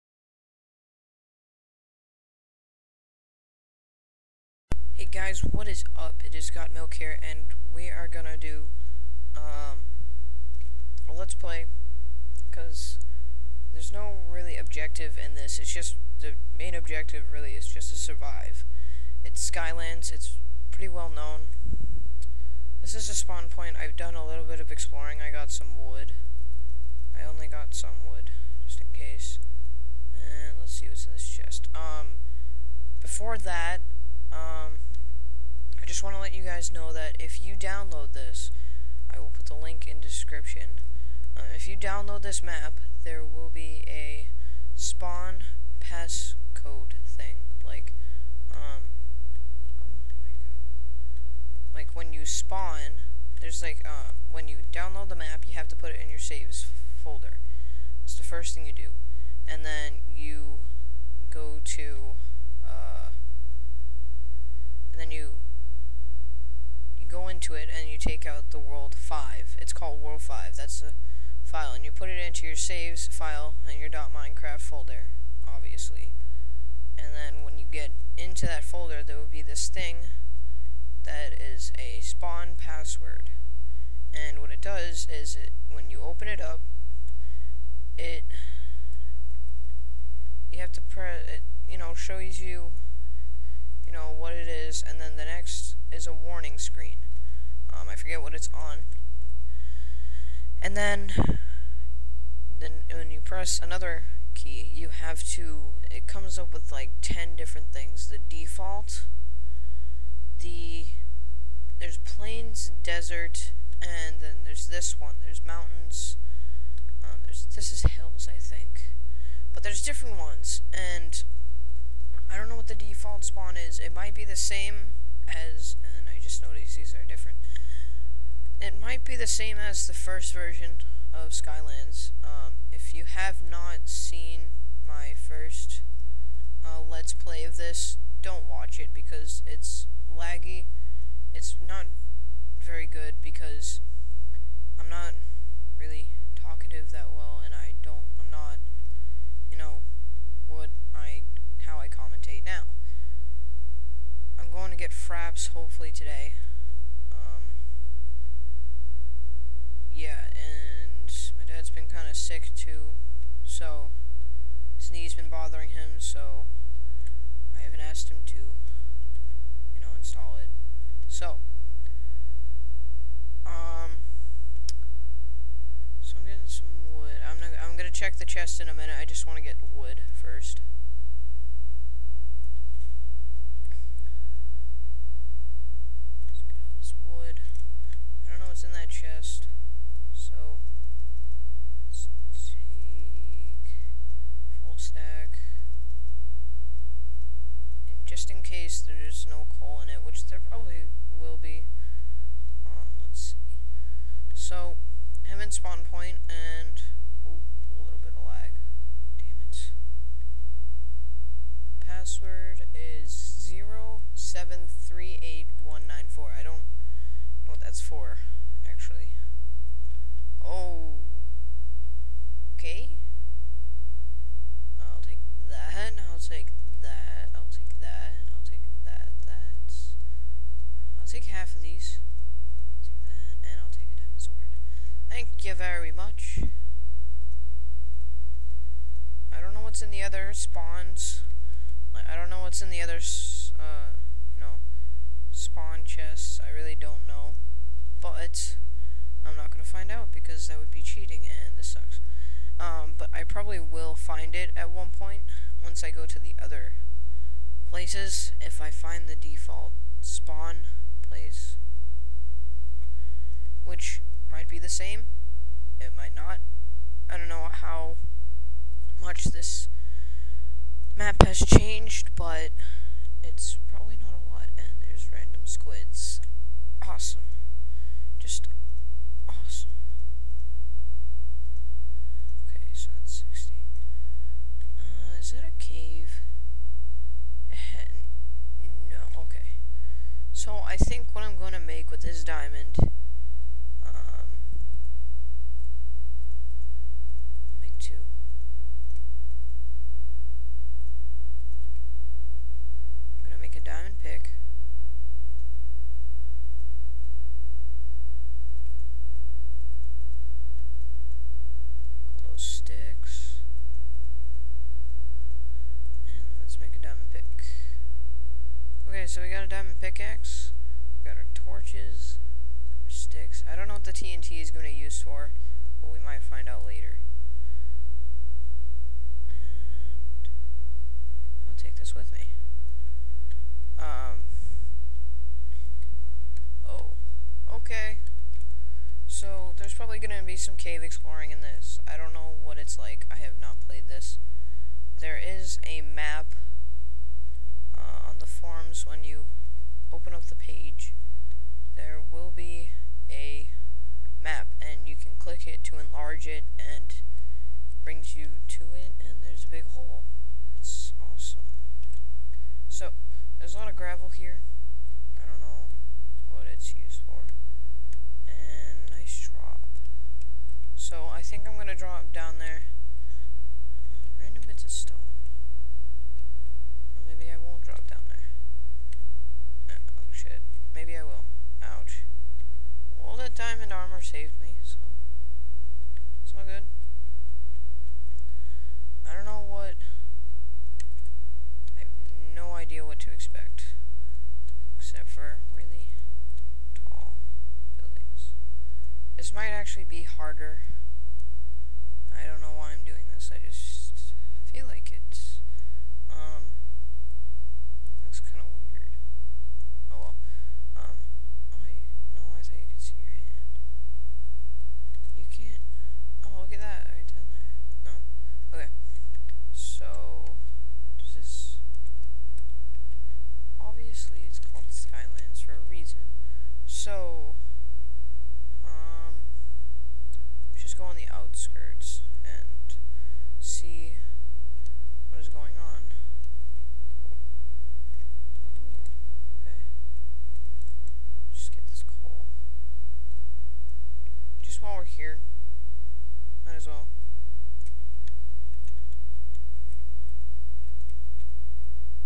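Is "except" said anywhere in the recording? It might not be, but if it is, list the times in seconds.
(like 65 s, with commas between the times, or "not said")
394 s.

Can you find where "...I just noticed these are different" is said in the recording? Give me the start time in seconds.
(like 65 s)
126 s.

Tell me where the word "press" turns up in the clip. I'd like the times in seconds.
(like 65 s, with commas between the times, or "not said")
90 s, 103 s.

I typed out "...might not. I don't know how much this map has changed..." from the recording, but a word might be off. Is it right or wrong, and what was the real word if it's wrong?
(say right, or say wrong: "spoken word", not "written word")
right.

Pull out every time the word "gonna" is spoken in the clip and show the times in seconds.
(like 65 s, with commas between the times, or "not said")
8 s, 177 s, 303 s, 371 s.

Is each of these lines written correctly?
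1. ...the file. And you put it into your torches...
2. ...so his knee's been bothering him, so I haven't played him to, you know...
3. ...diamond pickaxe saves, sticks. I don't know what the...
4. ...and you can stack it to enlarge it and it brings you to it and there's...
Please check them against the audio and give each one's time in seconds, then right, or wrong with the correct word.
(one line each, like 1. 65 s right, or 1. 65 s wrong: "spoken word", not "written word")
1. 70 s wrong: "saves", not "torches"
2. 163 s wrong: "asked", not "played"
3. 319 s wrong: "torches", not "saves"
4. 354 s wrong: "click", not "stack".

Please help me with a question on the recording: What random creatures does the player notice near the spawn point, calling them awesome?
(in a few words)
squids.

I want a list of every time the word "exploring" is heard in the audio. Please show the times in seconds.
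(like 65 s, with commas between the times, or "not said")
24 s, 340 s.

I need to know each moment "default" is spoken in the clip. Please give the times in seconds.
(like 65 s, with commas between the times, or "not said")
108 s, 122 s, 259 s.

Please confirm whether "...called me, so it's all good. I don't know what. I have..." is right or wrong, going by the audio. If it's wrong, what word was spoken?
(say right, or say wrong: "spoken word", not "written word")
wrong: "saved", not "called".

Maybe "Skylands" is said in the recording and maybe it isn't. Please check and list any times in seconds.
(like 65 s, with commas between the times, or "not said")
19 s, 131 s.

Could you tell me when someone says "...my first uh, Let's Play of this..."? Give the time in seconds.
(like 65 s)
134 s.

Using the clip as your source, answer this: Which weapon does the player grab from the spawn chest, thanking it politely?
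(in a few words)
diamond sword.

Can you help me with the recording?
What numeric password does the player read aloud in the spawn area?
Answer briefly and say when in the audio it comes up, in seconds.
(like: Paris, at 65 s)
0738194, at 213 s.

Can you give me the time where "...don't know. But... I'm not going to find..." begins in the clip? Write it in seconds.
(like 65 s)
246 s.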